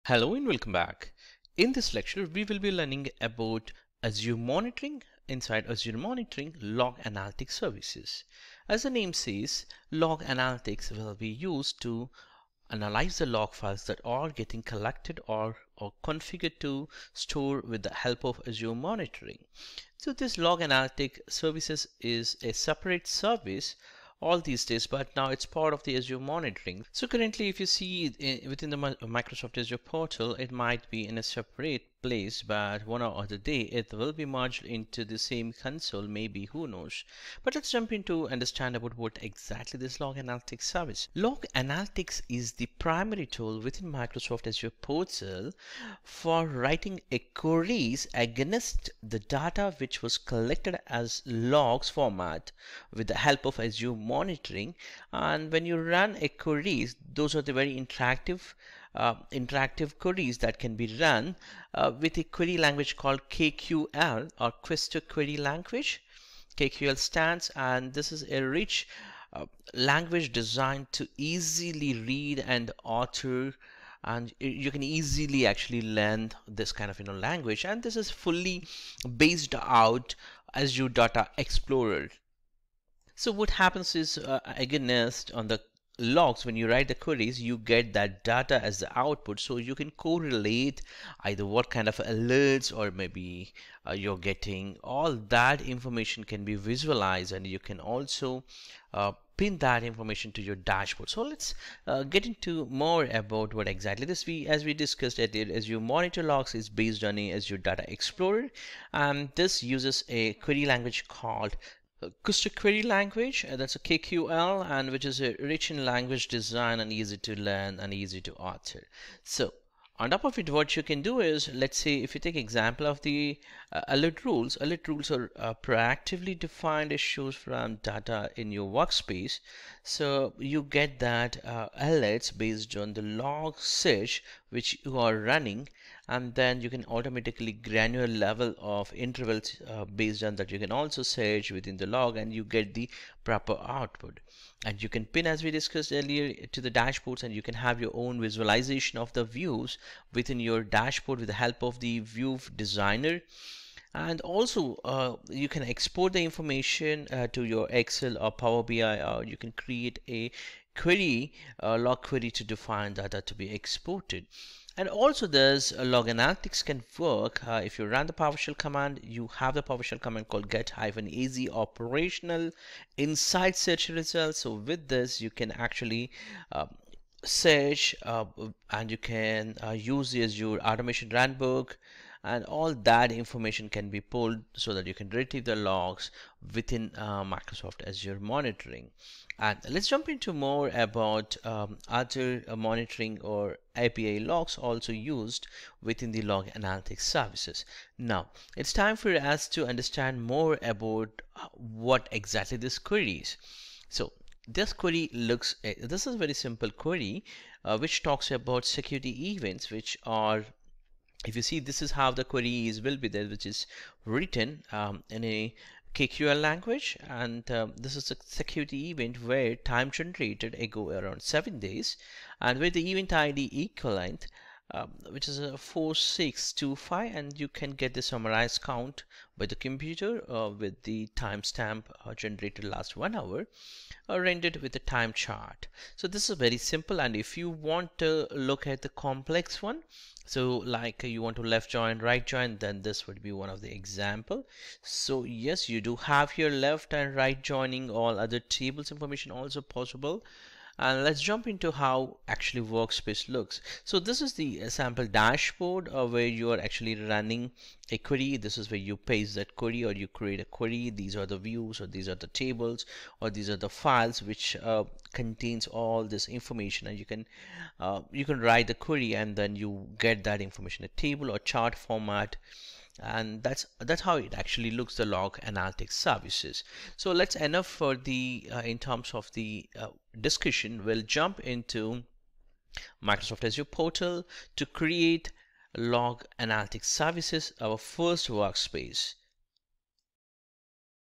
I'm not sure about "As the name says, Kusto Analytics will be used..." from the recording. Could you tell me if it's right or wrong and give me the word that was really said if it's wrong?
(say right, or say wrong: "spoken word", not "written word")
wrong: "Log", not "Kusto".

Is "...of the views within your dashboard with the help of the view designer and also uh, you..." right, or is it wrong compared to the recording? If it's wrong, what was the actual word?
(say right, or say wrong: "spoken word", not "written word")
right.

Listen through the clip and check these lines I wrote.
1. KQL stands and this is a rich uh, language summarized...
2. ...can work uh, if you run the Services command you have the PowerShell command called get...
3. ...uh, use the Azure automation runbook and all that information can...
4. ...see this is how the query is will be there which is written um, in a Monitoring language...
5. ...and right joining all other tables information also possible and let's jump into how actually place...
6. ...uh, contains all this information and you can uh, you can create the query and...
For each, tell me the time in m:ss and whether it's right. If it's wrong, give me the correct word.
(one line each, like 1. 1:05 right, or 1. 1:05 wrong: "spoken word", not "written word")
1. 1:06 wrong: "designed", not "summarized"
2. 2:46 wrong: "PowerShell", not "Services"
3. 2:59 right
4. 3:31 wrong: "KQL", not "Monitoring"
5. 4:06 wrong: "workspace", not "place"
6. 4:24 wrong: "write", not "create".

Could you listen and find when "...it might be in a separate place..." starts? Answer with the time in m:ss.
0:30.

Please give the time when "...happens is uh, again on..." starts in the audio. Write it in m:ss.
1:23.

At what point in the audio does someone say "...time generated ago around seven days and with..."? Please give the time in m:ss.
3:39.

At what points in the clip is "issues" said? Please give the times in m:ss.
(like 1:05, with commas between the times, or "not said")
2:06.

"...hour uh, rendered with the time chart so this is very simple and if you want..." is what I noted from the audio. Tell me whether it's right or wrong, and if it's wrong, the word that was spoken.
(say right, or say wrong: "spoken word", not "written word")
right.